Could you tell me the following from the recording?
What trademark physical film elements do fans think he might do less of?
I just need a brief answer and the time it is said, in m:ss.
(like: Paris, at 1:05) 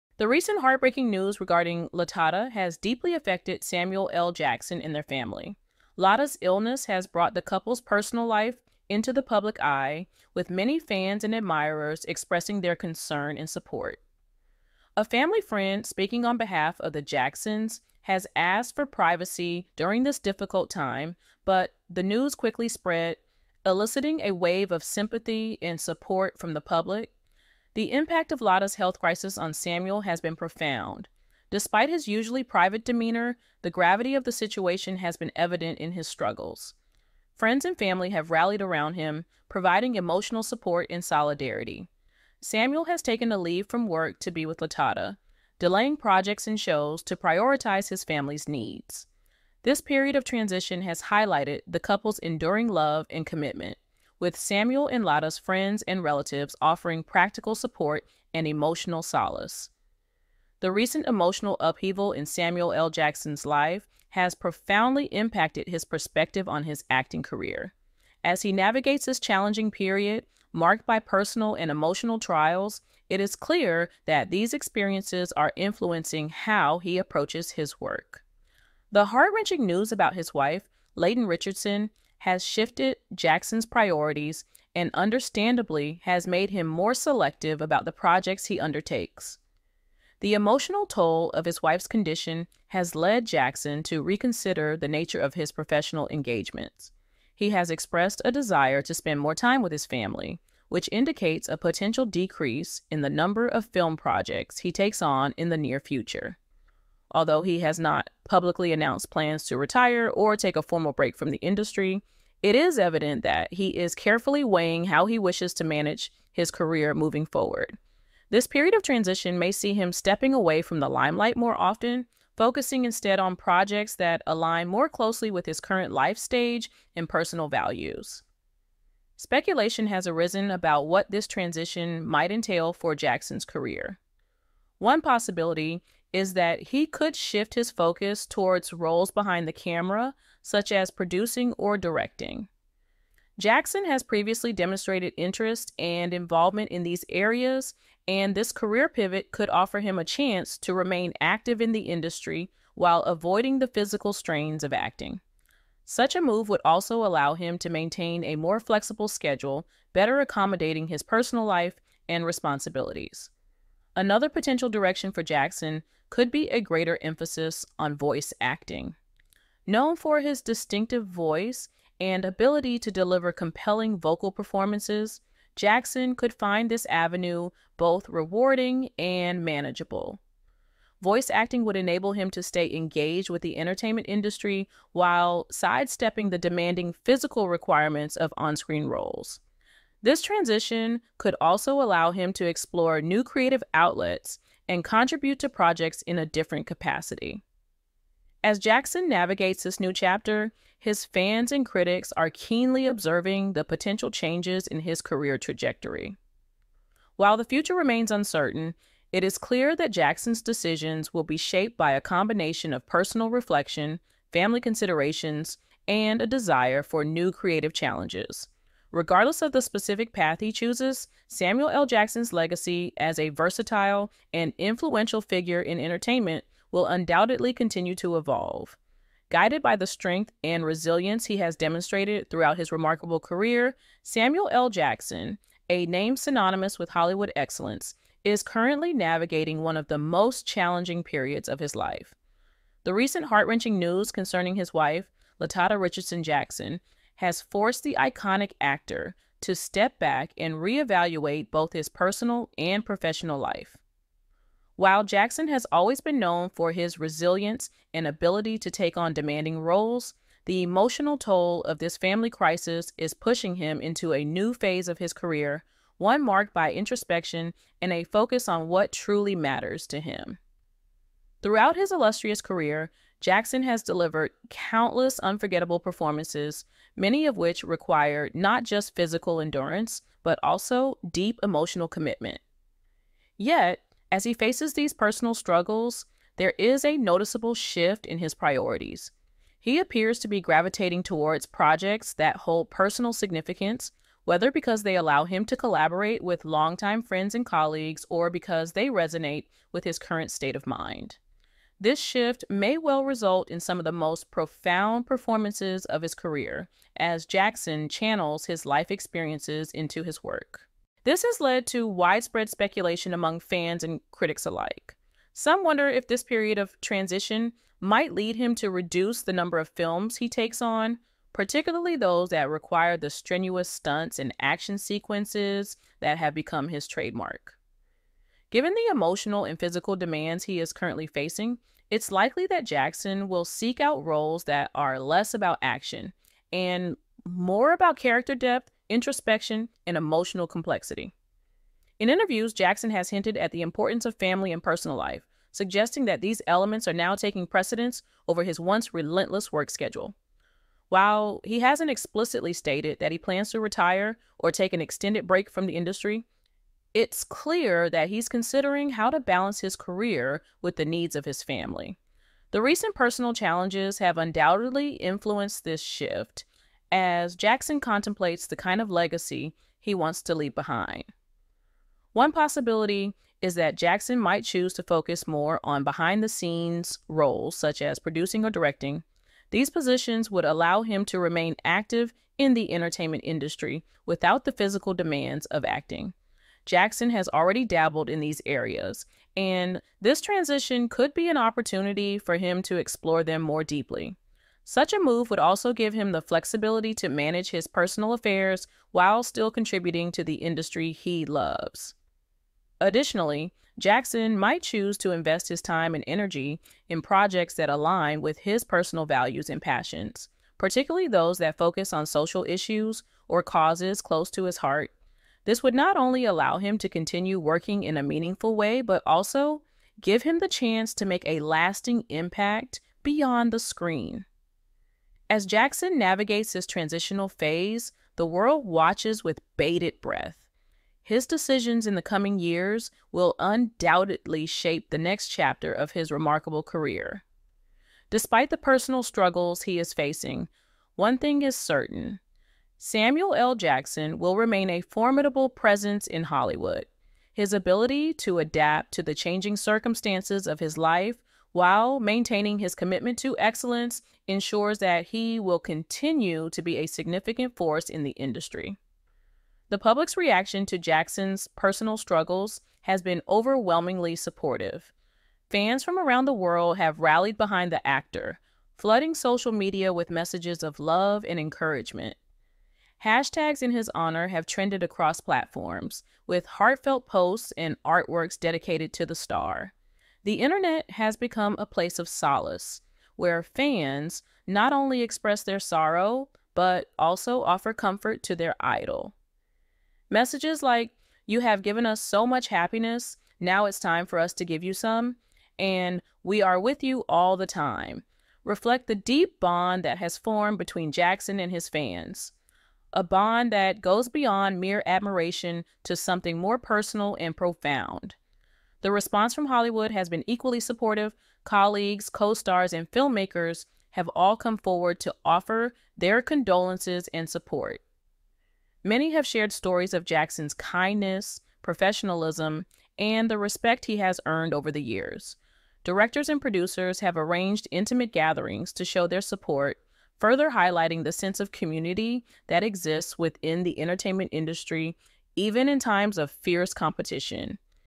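Stunts and action sequences, at 5:23.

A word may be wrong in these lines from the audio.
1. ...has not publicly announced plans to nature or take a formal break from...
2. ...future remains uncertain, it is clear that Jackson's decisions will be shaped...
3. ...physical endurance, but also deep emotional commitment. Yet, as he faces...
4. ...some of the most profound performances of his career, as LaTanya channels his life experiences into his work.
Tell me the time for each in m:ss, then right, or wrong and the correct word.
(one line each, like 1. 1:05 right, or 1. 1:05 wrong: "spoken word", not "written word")
1. 1:47 wrong: "retire", not "nature"
2. 3:27 right
3. 4:38 right
4. 5:03 wrong: "Jackson", not "LaTanya".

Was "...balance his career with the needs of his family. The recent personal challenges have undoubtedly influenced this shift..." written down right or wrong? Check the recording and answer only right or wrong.
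right.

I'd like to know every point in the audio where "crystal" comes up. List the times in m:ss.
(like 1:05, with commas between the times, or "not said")
not said.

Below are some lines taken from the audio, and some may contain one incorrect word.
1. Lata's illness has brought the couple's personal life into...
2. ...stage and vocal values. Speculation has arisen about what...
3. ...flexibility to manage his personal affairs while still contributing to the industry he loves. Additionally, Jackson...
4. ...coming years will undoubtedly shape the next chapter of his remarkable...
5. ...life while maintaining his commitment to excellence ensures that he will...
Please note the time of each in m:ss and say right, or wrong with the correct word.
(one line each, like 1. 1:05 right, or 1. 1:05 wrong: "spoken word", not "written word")
1. 0:05 right
2. 2:06 wrong: "personal", not "vocal"
3. 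6:36 right
4. 7:12 right
5. 7:30 right.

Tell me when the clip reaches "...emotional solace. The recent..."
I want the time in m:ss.
0:58.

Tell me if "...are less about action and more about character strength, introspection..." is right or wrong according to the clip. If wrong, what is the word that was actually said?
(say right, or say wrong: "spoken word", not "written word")
wrong: "depth", not "strength".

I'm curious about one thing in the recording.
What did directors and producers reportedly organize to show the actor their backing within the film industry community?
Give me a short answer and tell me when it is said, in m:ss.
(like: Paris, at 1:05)
Intimate gatherings, at 8:47.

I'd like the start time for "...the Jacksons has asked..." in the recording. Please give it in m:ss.
0:16.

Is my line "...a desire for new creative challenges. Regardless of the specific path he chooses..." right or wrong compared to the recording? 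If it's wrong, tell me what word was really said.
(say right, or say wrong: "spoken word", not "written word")
right.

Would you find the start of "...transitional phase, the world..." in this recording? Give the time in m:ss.
7:06.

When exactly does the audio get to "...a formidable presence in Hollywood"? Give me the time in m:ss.
7:24.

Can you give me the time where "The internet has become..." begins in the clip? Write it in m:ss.
8:00.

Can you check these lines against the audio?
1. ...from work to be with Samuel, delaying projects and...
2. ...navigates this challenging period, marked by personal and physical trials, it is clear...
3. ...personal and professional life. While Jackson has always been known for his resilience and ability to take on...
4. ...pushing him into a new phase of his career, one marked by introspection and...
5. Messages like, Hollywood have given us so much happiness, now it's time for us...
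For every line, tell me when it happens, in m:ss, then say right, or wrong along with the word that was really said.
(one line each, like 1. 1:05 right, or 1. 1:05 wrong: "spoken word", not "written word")
1. 0:43 wrong: "LaTanya", not "Samuel"
2. 1:08 wrong: "emotional", not "physical"
3. 4:11 right
4. 4:23 right
5. 8:10 wrong: "You", not "Hollywood".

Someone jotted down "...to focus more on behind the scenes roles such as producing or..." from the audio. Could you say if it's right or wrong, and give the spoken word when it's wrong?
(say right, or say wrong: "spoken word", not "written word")
right.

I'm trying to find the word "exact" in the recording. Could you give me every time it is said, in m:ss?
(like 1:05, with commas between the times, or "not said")
not said.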